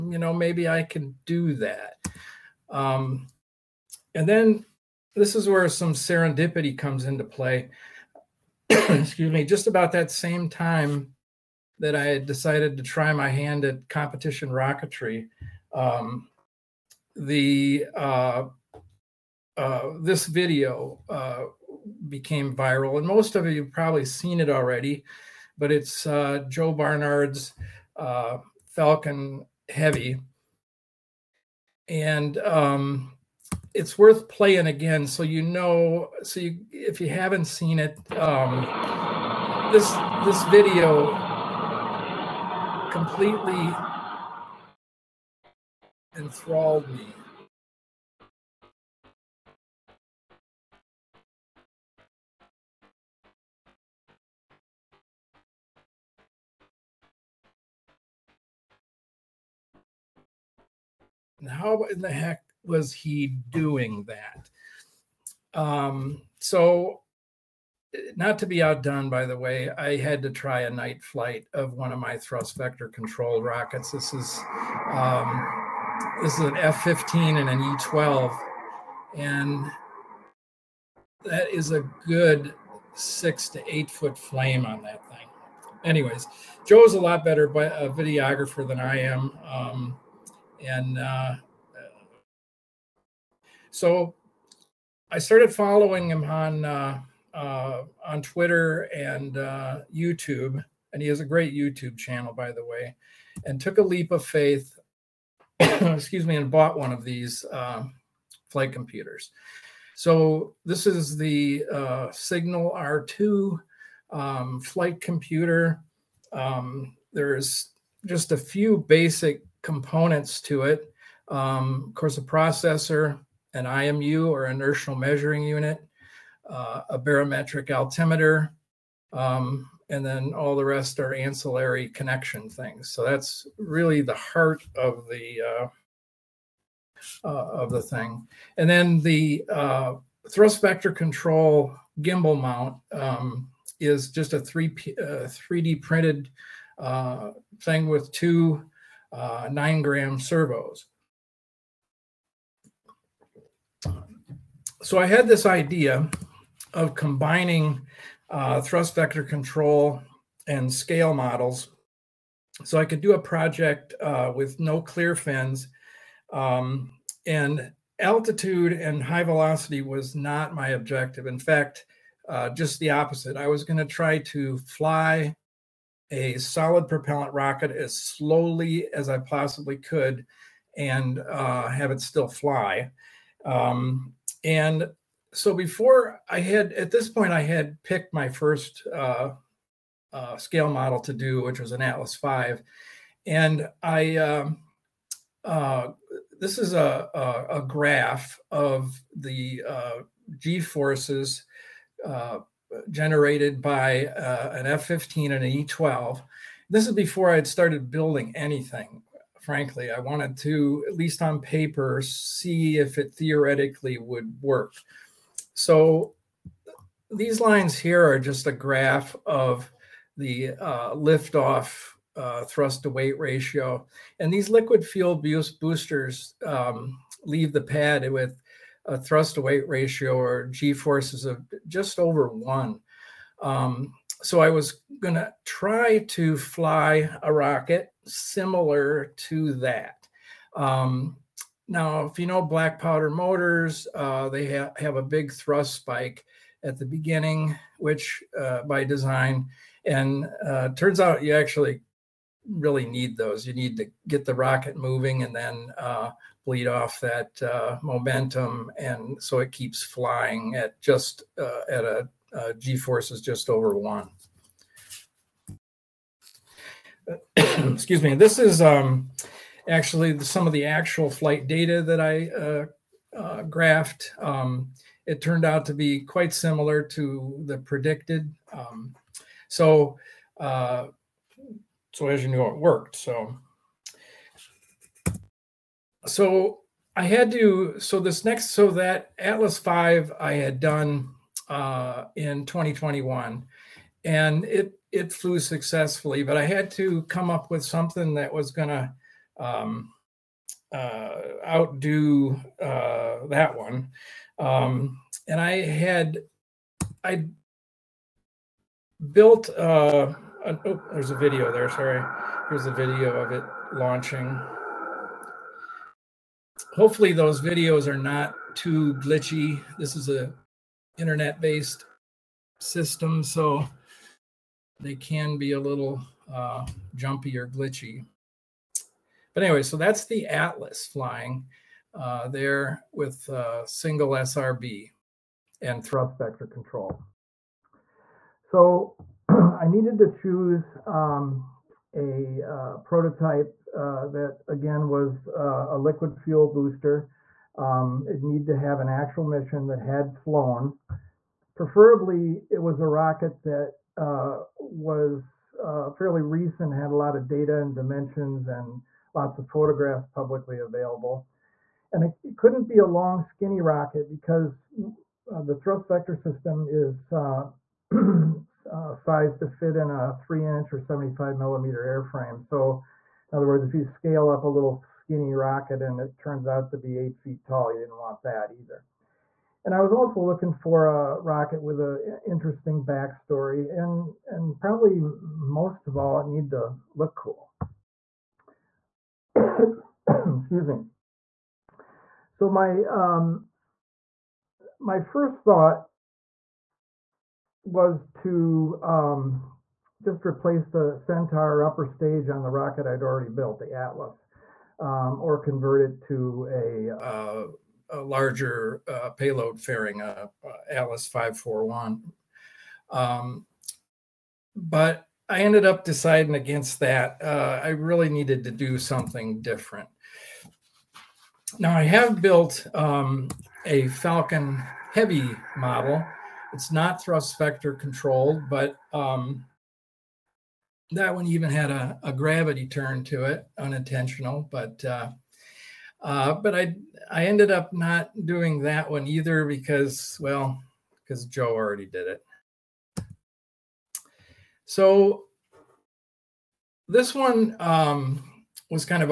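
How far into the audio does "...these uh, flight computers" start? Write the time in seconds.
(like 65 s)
107 s.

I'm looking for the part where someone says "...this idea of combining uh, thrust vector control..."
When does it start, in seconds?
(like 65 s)
155 s.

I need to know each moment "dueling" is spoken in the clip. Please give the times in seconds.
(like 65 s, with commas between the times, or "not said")
not said.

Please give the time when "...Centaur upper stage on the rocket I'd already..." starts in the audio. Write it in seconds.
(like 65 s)
400 s.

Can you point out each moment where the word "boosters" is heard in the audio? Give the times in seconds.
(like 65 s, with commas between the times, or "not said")
225 s, 346 s.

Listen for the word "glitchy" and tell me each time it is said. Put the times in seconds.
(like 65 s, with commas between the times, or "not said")
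318 s, 327 s.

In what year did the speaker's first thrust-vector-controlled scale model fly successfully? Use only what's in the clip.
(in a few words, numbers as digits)
2021.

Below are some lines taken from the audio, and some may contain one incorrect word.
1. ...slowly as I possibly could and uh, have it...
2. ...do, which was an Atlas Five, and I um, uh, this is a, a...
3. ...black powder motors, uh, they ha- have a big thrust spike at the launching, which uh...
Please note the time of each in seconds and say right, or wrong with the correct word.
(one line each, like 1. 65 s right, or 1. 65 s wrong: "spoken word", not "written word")
1. 177 s right
2. 191 s right
3. 242 s wrong: "beginning", not "launching".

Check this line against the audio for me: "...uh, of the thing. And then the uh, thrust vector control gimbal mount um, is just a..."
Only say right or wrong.
right.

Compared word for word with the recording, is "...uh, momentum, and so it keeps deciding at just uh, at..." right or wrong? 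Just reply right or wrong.
wrong.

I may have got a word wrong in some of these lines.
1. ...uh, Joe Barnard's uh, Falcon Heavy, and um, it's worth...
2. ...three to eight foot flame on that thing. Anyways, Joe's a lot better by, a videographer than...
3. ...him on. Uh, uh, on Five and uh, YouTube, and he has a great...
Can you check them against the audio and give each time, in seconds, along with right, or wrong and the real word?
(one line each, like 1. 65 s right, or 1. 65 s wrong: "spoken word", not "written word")
1. 26 s right
2. 82 s wrong: "six", not "three"
3. 96 s wrong: "Twitter", not "Five".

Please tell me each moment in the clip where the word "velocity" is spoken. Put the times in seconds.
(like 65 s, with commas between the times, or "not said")
169 s.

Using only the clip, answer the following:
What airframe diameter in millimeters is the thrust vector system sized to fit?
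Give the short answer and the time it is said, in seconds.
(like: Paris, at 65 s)
75 millimeters, at 370 s.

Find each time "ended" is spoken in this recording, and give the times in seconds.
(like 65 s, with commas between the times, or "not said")
415 s, 437 s.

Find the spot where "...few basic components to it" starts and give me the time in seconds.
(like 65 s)
118 s.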